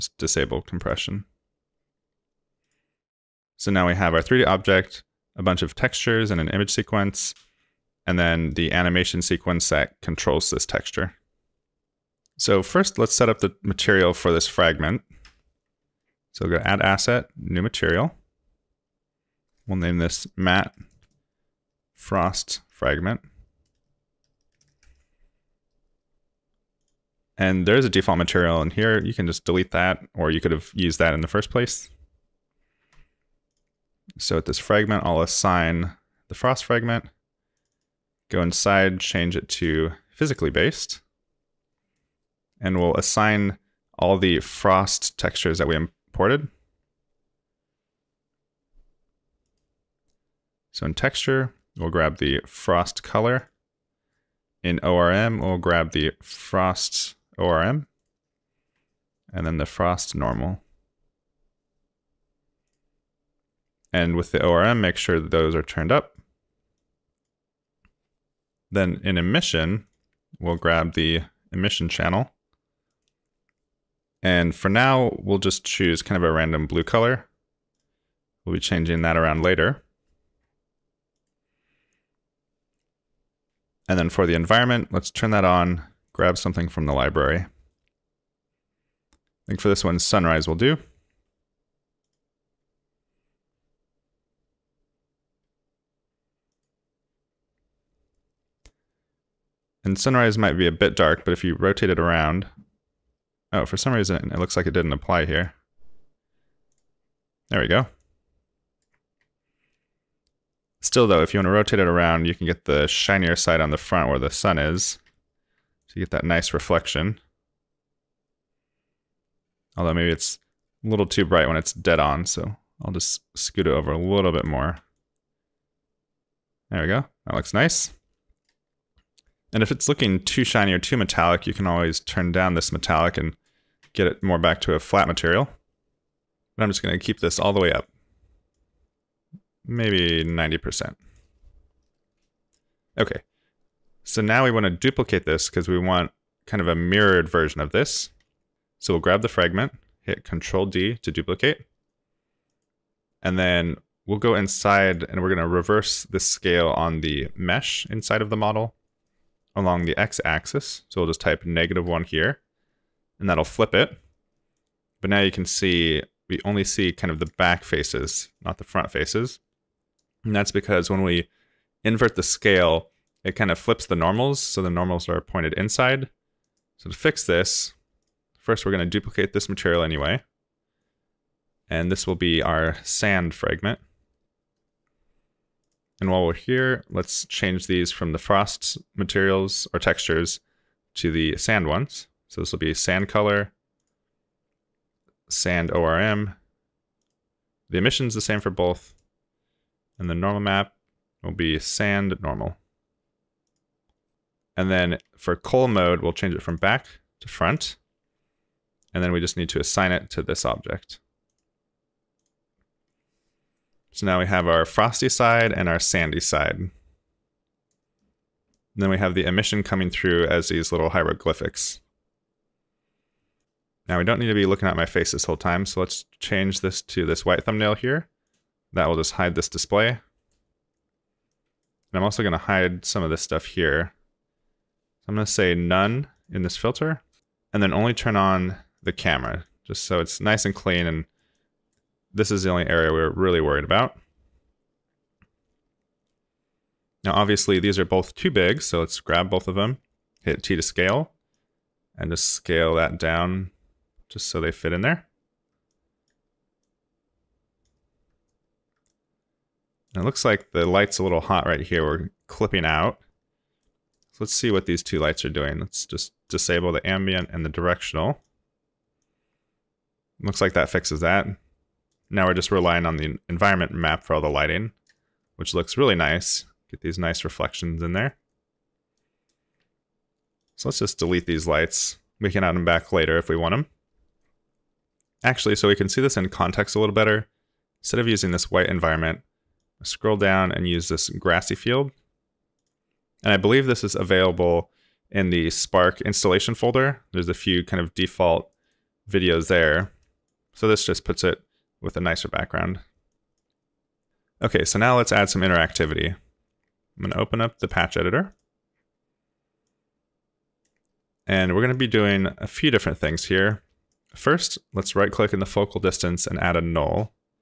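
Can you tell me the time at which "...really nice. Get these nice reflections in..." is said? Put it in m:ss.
4:35.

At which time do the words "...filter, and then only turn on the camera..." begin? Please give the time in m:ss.
3:56.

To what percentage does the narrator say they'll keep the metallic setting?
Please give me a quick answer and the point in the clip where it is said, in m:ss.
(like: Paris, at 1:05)
90%, at 2:20.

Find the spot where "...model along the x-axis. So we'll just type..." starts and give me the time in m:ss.
2:38.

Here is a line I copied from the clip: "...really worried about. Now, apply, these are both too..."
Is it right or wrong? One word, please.
wrong.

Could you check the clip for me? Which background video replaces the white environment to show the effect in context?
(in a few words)
Grassy field.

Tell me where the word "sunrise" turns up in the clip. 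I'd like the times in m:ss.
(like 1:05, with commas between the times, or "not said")
1:29, 1:39.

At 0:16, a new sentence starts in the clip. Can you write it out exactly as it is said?
So we'll go to Add Asset, New Material.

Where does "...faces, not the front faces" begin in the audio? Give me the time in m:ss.
2:47.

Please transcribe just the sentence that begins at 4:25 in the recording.
Let's just disable the ambient and the directional.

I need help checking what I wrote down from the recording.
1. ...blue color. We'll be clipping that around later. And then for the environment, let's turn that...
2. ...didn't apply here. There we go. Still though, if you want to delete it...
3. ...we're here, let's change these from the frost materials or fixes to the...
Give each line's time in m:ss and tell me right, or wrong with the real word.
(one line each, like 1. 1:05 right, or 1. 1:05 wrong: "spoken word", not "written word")
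1. 1:16 wrong: "changing", not "clipping"
2. 1:44 wrong: "rotate", not "delete"
3. 3:06 wrong: "textures", not "fixes".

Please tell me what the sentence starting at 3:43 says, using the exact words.
Now we don't need to be looking at my face this whole time, so let's change this to this white thumbnail here.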